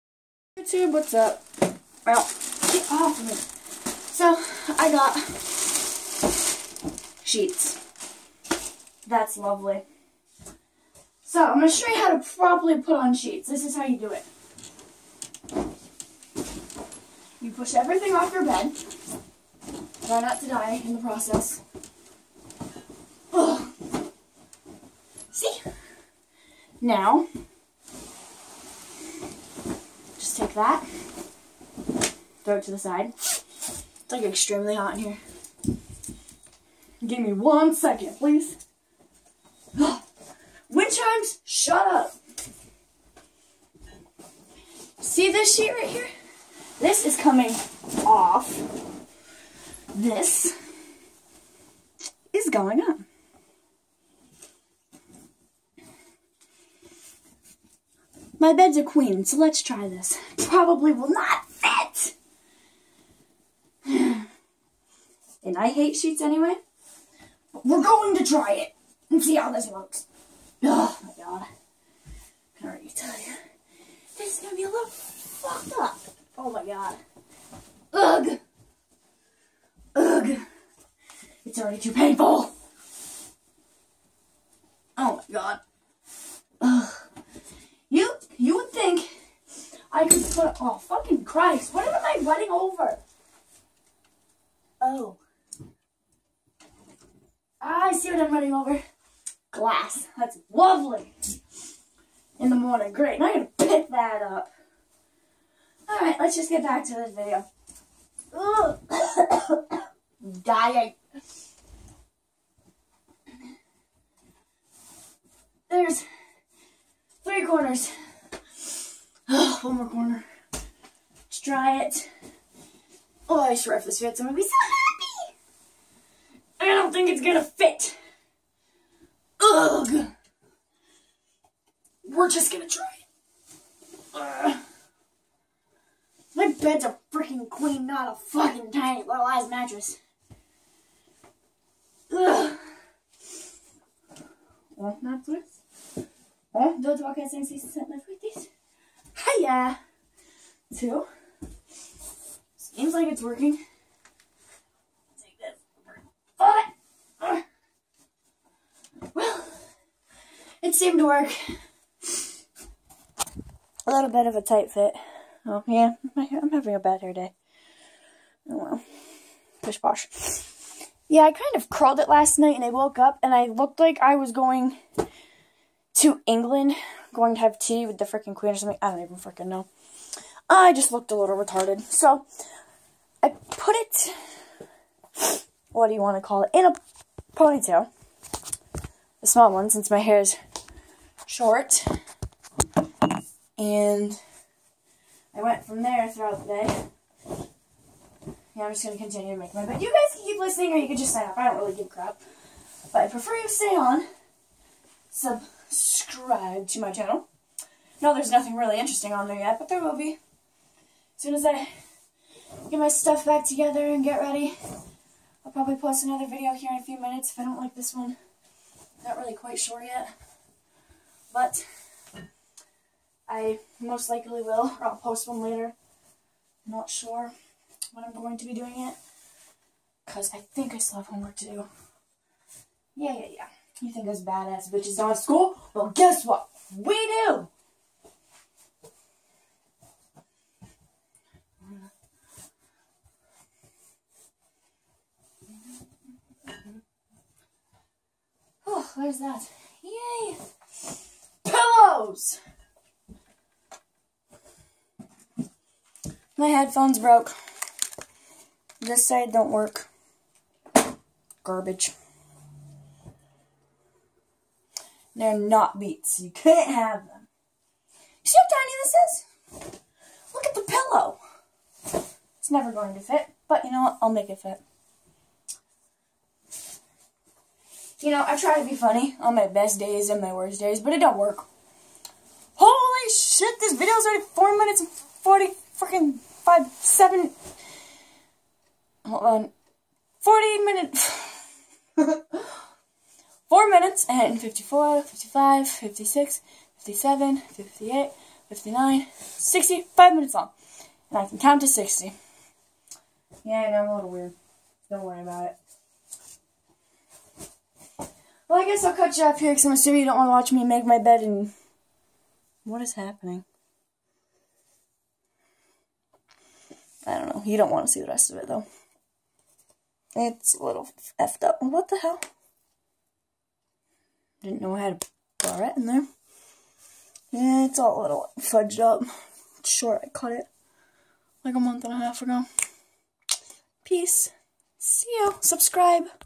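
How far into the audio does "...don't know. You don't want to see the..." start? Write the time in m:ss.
5:17.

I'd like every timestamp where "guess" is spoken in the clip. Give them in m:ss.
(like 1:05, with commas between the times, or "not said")
3:55, 5:08.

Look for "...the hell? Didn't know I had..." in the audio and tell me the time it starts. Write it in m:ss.
5:21.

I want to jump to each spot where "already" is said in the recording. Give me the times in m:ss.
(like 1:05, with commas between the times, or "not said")
1:12, 1:21, 4:44.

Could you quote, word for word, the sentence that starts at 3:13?
And I went from there throughout the day.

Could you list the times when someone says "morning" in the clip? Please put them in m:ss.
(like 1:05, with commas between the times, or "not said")
1:42.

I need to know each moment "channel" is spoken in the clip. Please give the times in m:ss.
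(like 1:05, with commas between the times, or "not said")
3:26.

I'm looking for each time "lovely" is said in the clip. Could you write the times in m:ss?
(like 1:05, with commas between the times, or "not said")
0:09, 1:40.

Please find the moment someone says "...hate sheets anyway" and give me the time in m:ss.
1:05.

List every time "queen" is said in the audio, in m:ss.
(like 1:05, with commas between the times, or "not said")
0:58, 2:17, 2:58.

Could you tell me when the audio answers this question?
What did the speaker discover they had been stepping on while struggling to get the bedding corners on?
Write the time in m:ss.
1:39.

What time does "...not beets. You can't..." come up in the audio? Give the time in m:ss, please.
4:25.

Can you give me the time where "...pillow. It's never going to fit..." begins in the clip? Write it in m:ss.
4:30.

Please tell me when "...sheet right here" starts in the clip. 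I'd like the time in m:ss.
0:45.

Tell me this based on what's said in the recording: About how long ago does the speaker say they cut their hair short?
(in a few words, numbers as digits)
A month and a half.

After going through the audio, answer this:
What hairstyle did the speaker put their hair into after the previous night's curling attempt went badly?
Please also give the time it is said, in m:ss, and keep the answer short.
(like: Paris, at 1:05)
Ponytail, at 3:07.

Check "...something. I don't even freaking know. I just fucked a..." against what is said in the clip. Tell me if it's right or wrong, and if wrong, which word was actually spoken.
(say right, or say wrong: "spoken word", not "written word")
wrong: "looked", not "fucked".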